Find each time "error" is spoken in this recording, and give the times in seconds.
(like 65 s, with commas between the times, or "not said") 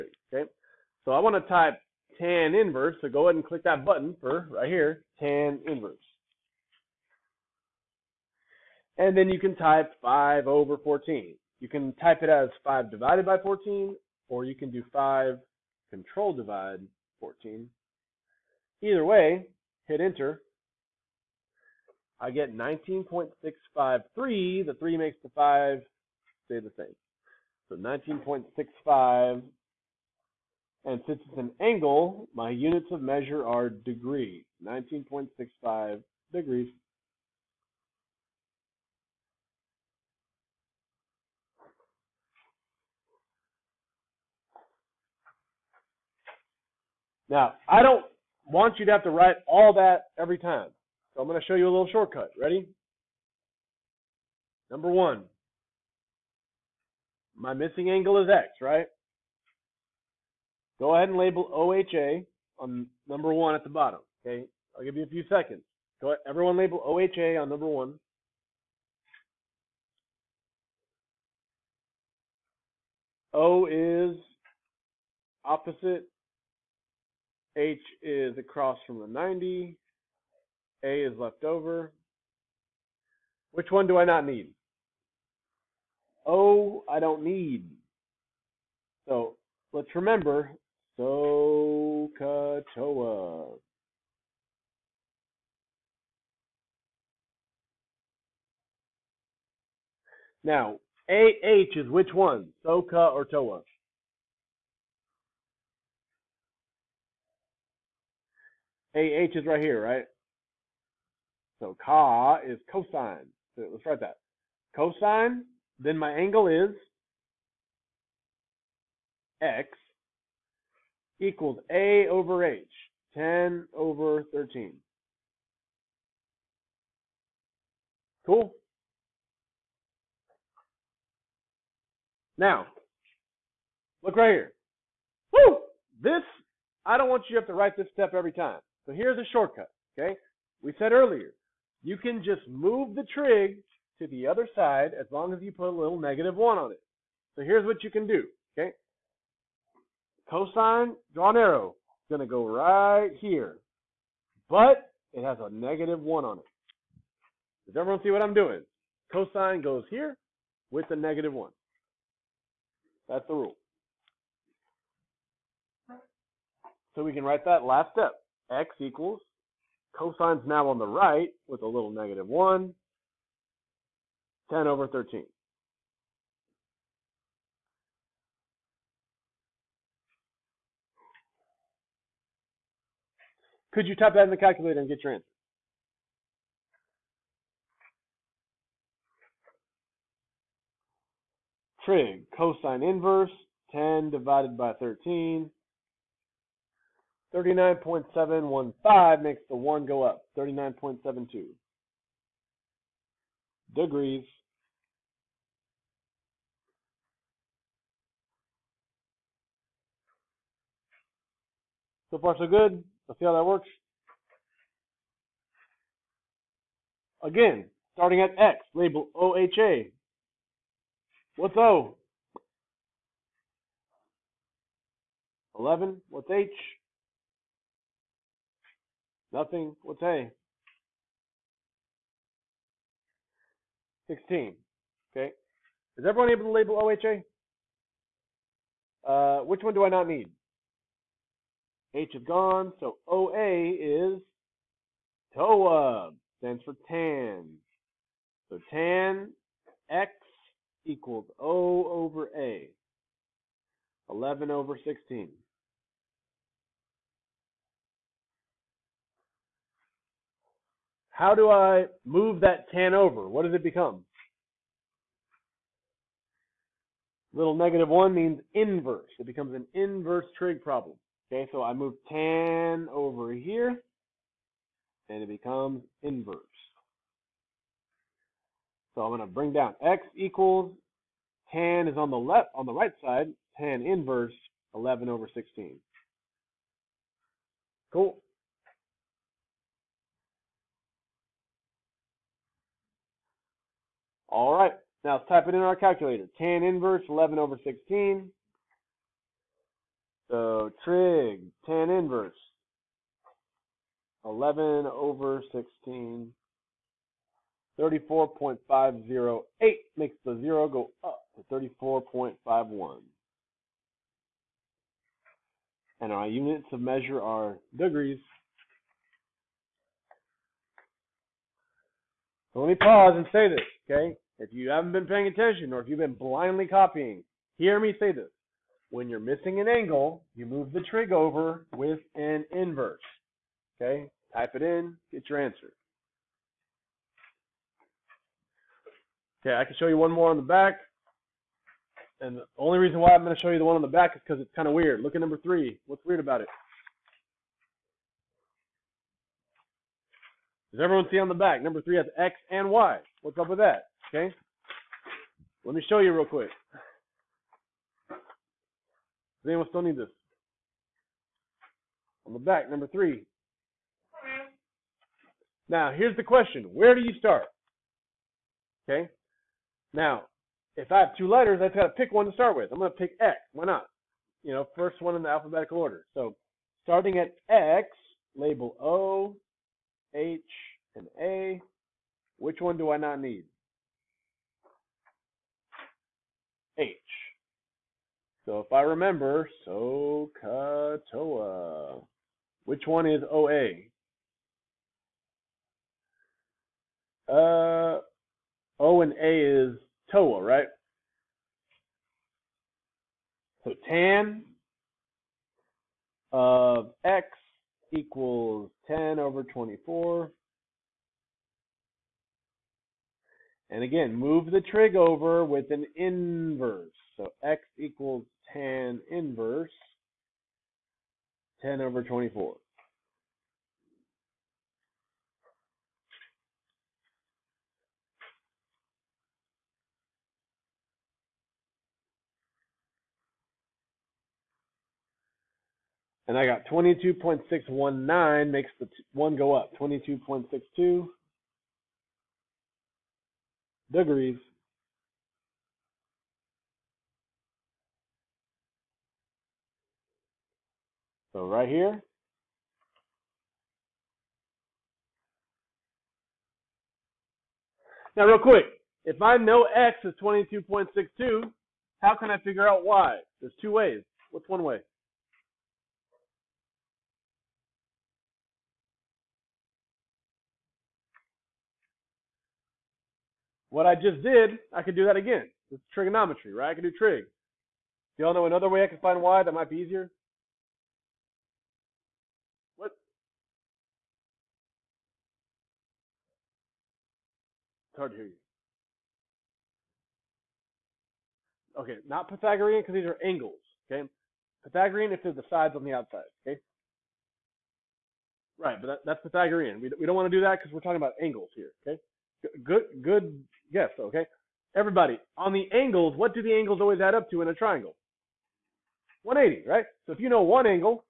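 not said.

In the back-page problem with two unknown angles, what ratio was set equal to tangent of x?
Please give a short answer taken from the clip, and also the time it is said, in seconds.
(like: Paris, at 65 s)
10 over 24, at 408 s.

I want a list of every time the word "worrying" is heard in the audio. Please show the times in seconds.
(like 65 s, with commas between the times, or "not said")
not said.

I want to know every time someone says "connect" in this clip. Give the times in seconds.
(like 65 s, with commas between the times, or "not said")
not said.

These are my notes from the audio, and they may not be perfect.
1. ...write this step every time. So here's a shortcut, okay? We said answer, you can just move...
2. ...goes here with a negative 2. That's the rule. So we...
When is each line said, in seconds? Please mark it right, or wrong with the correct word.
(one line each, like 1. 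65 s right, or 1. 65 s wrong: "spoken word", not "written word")
1. 137 s wrong: "earlier", not "answer"
2. 159 s wrong: "1", not "2".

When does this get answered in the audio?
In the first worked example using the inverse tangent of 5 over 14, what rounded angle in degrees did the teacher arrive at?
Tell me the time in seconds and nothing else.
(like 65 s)
27 s.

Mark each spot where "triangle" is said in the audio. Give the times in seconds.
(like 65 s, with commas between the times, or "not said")
507 s.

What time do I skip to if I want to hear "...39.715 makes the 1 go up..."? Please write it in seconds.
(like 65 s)
197 s.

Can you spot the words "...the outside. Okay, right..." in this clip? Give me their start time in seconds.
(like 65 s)
495 s.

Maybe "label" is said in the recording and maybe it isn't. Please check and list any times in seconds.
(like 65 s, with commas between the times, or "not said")
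61 s, 66 s, 218 s, 236 s, 378 s.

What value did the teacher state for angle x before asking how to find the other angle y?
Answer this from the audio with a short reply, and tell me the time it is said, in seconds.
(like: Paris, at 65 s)
22.62, at 460 s.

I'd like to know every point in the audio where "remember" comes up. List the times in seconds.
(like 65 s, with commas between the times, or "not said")
89 s, 388 s.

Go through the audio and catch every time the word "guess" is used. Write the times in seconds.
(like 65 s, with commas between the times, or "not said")
503 s.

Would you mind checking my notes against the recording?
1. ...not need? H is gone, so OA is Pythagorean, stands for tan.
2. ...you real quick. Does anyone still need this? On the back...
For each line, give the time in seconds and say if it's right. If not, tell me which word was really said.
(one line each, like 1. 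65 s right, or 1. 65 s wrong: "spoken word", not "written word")
1. 239 s wrong: "TOA", not "Pythagorean"
2. 355 s right.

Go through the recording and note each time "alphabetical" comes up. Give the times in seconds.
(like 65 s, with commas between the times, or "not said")
375 s.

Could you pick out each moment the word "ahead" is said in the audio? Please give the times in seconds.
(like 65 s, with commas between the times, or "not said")
3 s, 60 s, 66 s.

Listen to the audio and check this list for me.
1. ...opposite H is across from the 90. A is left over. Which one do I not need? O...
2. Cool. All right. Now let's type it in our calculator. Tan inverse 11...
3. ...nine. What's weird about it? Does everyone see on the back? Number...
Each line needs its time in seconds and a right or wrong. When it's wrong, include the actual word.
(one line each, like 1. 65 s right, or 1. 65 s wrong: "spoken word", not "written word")
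1. 75 s right
2. 287 s right
3. 345 s wrong: "three", not "nine".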